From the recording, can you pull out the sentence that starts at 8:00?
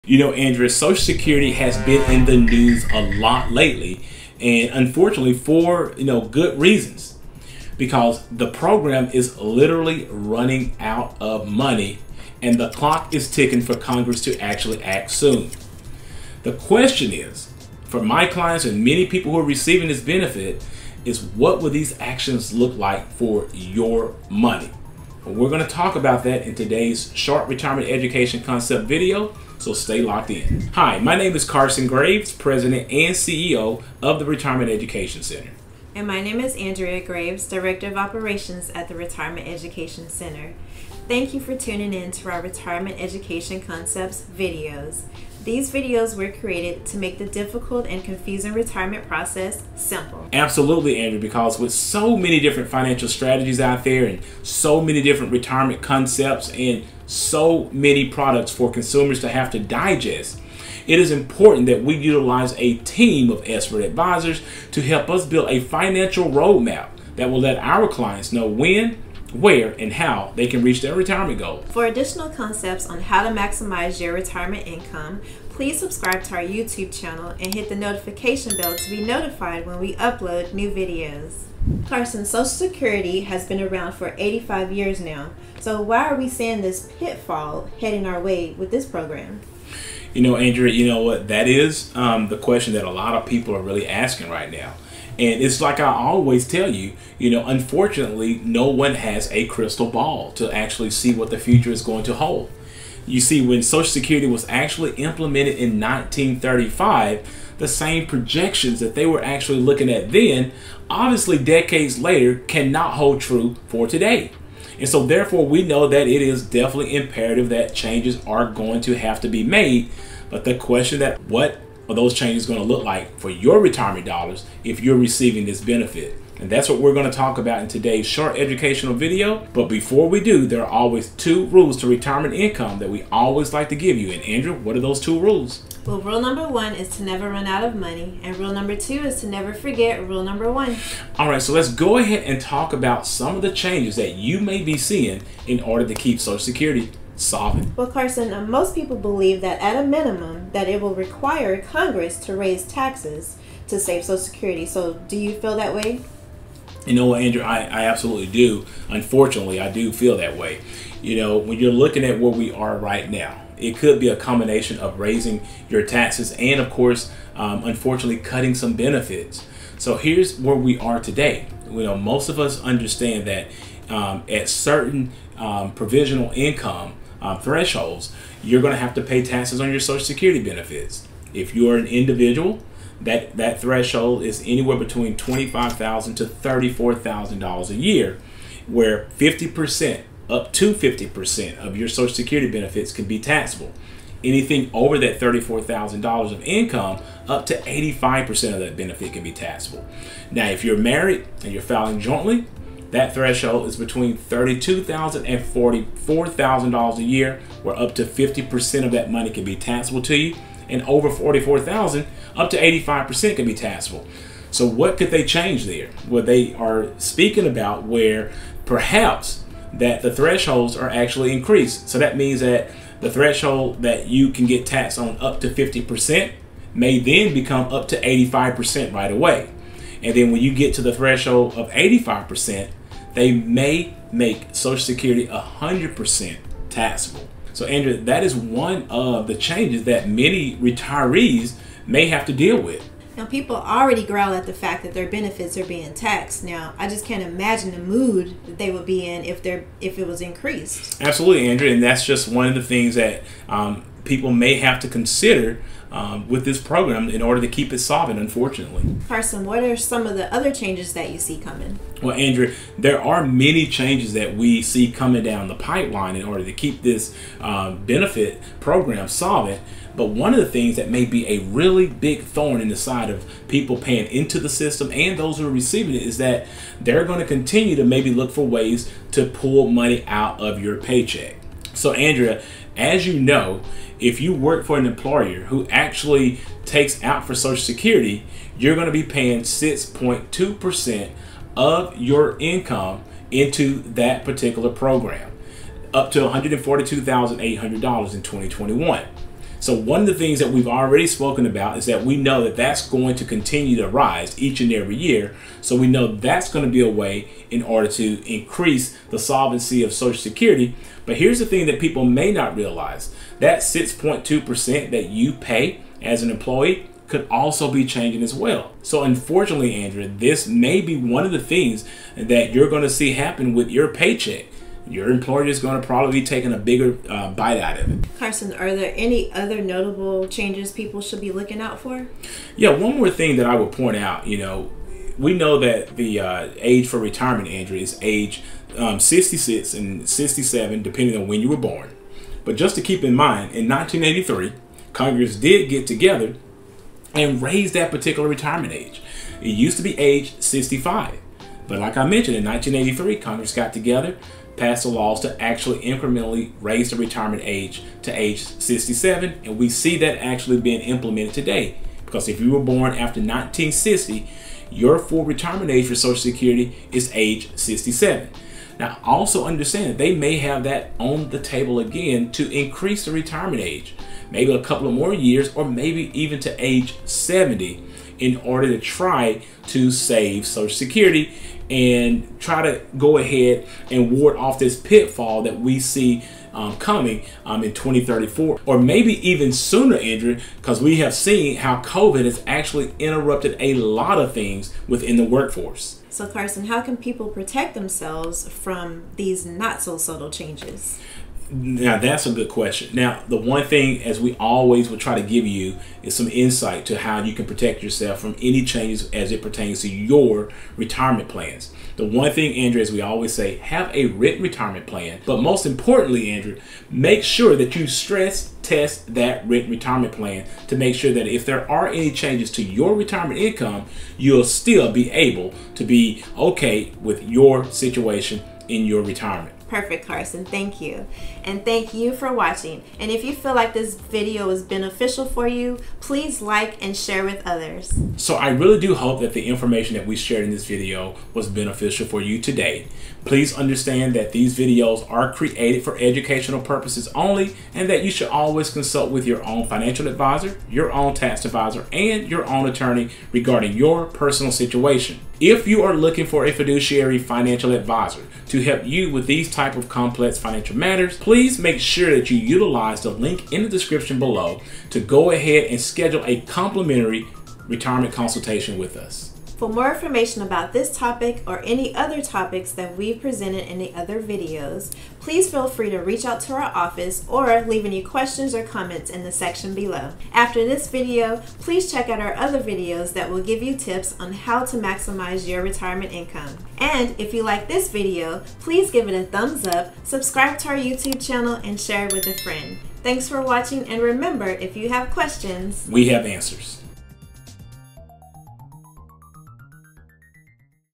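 After this video, please check out our other videos that will give you tips on how to maximize your retirement income.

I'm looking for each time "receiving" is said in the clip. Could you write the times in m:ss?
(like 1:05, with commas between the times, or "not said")
0:19, 2:04, 4:35.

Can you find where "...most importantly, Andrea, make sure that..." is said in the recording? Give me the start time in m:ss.
6:55.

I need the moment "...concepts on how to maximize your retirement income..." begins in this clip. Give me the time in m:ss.
1:12.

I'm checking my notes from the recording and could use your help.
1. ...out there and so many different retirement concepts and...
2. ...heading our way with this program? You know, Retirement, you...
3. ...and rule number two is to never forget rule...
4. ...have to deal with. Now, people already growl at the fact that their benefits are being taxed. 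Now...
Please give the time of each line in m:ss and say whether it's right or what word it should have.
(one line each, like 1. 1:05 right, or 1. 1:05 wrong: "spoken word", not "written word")
1. 0:53 right
2. 1:27 wrong: "Andrea", not "Retirement"
3. 2:18 right
4. 4:02 right.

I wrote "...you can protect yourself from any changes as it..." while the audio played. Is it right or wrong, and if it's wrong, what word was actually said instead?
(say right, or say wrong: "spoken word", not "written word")
right.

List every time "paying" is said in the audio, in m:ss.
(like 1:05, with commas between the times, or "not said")
4:33, 4:49.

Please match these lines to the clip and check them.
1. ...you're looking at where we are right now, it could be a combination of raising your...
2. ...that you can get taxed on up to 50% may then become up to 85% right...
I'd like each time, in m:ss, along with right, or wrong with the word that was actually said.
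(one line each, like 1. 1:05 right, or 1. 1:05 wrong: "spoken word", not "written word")
1. 2:41 right
2. 3:43 right.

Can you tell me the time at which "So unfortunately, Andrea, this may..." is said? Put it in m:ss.
5:18.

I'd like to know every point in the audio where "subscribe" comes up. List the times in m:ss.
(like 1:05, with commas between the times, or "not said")
1:15, 8:10.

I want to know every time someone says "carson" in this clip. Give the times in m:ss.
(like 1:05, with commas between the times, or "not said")
0:31, 1:21, 2:27, 4:19, 5:28, 6:36, 7:10.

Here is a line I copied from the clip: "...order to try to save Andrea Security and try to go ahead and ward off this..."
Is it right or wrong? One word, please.
wrong.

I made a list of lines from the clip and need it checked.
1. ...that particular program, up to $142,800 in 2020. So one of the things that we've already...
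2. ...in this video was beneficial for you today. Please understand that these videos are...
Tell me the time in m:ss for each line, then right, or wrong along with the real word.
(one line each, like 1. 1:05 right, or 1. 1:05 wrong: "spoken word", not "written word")
1. 4:53 wrong: "2021", not "2020"
2. 7:20 right.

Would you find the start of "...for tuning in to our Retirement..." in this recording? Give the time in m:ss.
0:41.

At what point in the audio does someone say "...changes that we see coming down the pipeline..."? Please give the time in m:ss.
4:23.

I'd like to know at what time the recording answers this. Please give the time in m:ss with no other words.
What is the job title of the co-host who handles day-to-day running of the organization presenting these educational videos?
0:37.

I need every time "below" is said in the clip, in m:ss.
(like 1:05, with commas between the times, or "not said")
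7:44, 7:59.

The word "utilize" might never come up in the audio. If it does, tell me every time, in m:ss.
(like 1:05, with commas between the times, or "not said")
1:01, 7:42.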